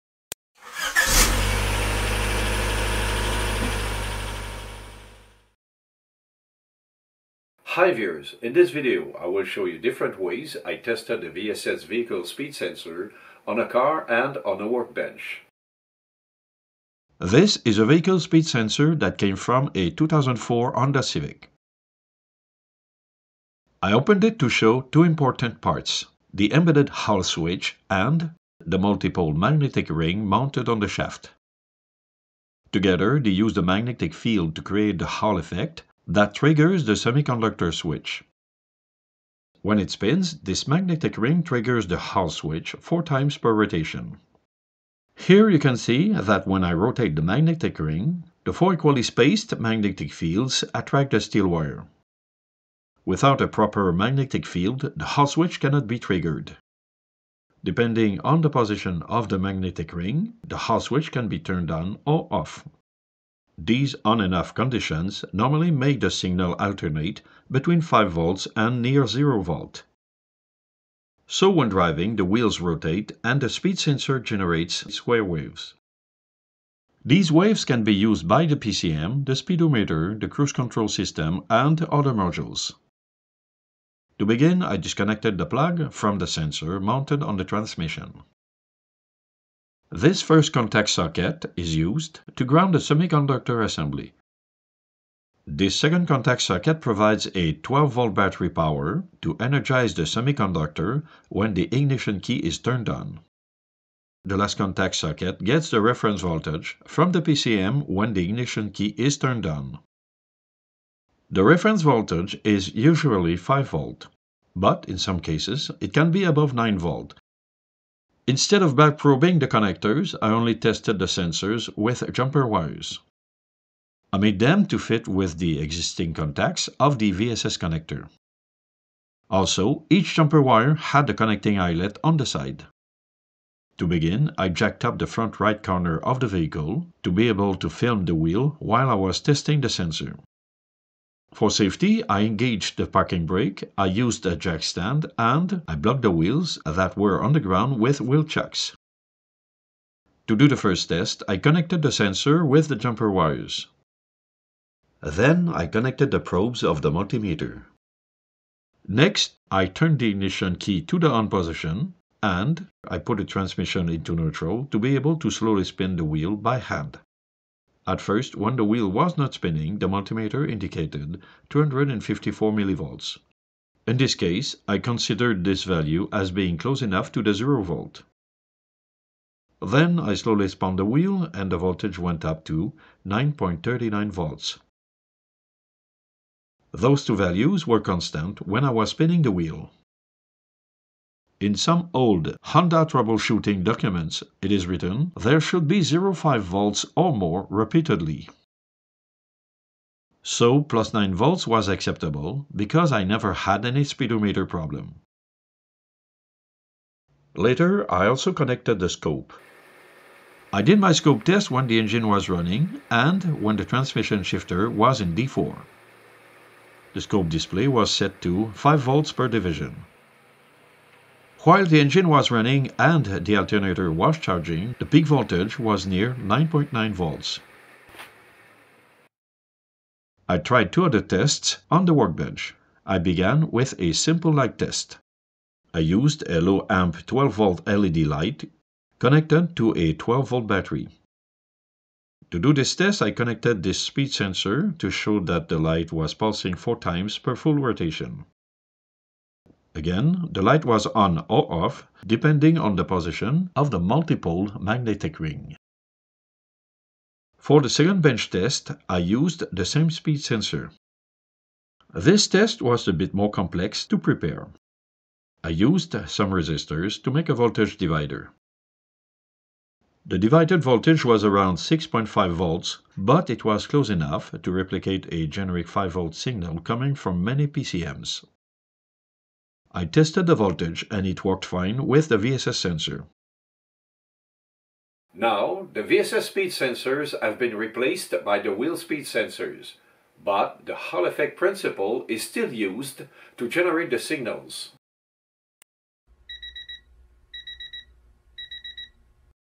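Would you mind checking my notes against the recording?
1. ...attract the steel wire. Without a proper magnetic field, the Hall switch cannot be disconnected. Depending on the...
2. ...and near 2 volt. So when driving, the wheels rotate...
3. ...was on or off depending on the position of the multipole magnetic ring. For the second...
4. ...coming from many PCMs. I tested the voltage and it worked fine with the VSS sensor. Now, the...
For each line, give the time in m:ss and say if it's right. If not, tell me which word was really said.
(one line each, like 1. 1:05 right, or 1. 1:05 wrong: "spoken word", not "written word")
1. 0:50 wrong: "triggered", not "disconnected"
2. 1:08 wrong: "0", not "2"
3. 4:10 right
4. 4:36 right.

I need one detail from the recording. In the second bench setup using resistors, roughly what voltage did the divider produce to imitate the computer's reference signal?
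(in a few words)
6.5 volts.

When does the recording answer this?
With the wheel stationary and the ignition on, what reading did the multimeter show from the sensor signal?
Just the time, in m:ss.
2:51.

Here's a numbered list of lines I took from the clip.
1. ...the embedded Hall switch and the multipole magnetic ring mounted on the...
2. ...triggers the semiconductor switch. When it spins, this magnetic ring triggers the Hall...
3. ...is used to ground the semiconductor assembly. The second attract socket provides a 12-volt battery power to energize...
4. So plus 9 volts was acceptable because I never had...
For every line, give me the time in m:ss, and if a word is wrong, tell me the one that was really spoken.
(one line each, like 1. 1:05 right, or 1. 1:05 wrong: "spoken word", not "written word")
1. 0:26 right
2. 0:36 right
3. 1:31 wrong: "contact", not "attract"
4. 3:20 right.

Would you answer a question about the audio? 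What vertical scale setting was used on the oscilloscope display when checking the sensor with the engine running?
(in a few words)
5 volts per division.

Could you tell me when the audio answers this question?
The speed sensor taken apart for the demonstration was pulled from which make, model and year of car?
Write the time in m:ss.
0:19.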